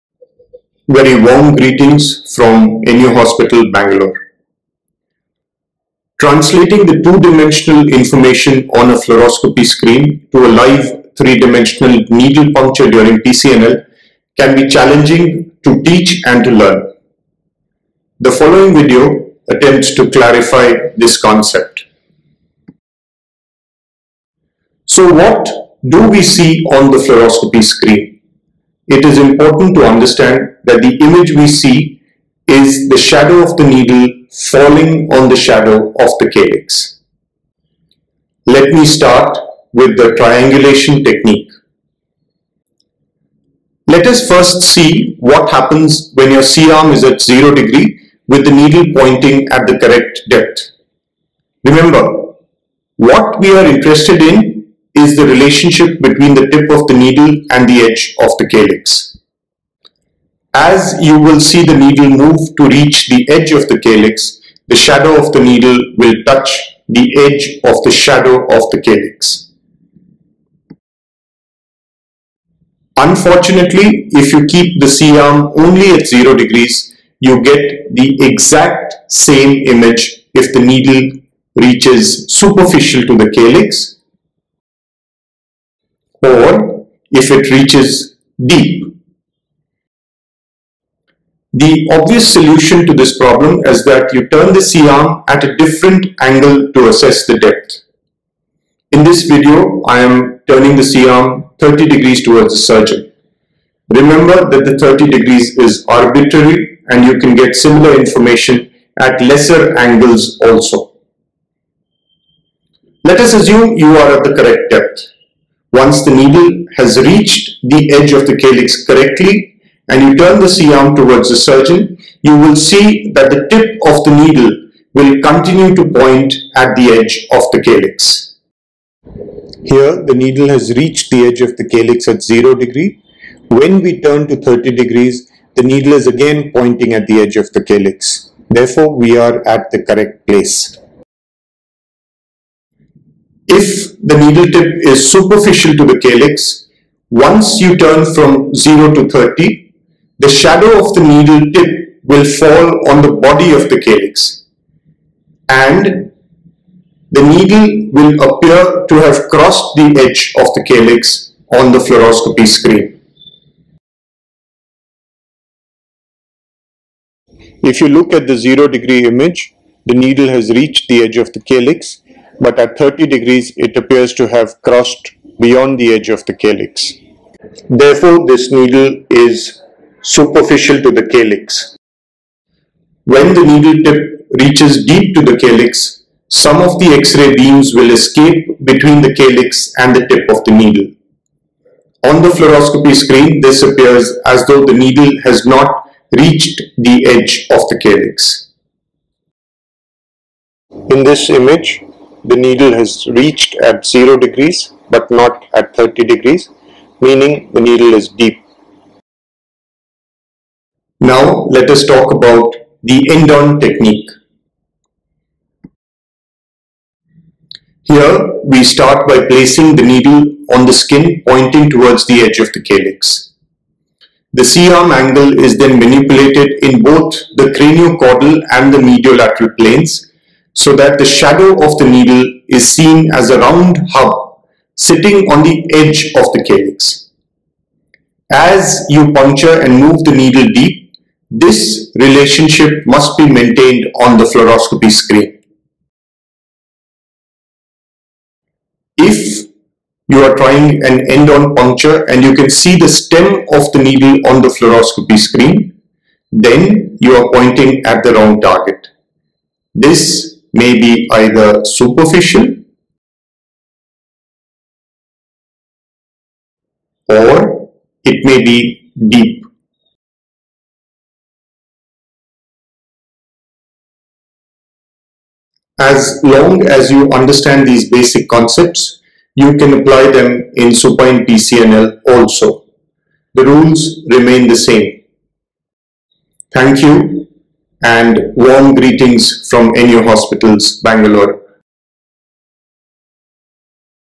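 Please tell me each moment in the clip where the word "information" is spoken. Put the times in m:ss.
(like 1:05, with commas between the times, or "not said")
0:07, 1:47.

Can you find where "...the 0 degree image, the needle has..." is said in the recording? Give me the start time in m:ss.
2:48.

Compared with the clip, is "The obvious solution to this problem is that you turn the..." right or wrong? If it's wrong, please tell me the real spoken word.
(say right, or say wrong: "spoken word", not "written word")
right.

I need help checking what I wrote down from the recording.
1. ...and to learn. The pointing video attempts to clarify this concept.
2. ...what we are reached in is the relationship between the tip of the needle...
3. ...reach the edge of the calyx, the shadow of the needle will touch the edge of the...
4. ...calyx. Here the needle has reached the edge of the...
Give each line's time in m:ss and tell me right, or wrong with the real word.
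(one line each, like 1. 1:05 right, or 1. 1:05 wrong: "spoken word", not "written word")
1. 0:16 wrong: "following", not "pointing"
2. 0:52 wrong: "interested", not "reached"
3. 1:02 right
4. 2:07 right.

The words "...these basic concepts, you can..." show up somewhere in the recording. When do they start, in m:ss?
4:37.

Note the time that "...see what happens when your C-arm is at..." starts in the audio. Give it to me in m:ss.
0:44.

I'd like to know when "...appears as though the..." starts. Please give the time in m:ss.
3:13.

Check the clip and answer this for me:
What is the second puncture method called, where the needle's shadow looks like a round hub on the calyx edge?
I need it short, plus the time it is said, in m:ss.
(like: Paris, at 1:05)
End on technique, at 3:33.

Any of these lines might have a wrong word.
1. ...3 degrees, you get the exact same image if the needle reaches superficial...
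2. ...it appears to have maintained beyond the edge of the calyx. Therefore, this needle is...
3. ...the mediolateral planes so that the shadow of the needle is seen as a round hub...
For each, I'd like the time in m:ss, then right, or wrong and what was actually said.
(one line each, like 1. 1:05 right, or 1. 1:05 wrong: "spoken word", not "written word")
1. 1:16 wrong: "0", not "3"
2. 2:53 wrong: "crossed", not "maintained"
3. 3:48 right.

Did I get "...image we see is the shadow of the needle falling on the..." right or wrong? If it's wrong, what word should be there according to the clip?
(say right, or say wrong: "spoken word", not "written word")
right.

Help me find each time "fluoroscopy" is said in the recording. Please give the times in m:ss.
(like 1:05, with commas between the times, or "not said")
0:08, 0:26, 2:41, 3:12, 4:04, 4:14.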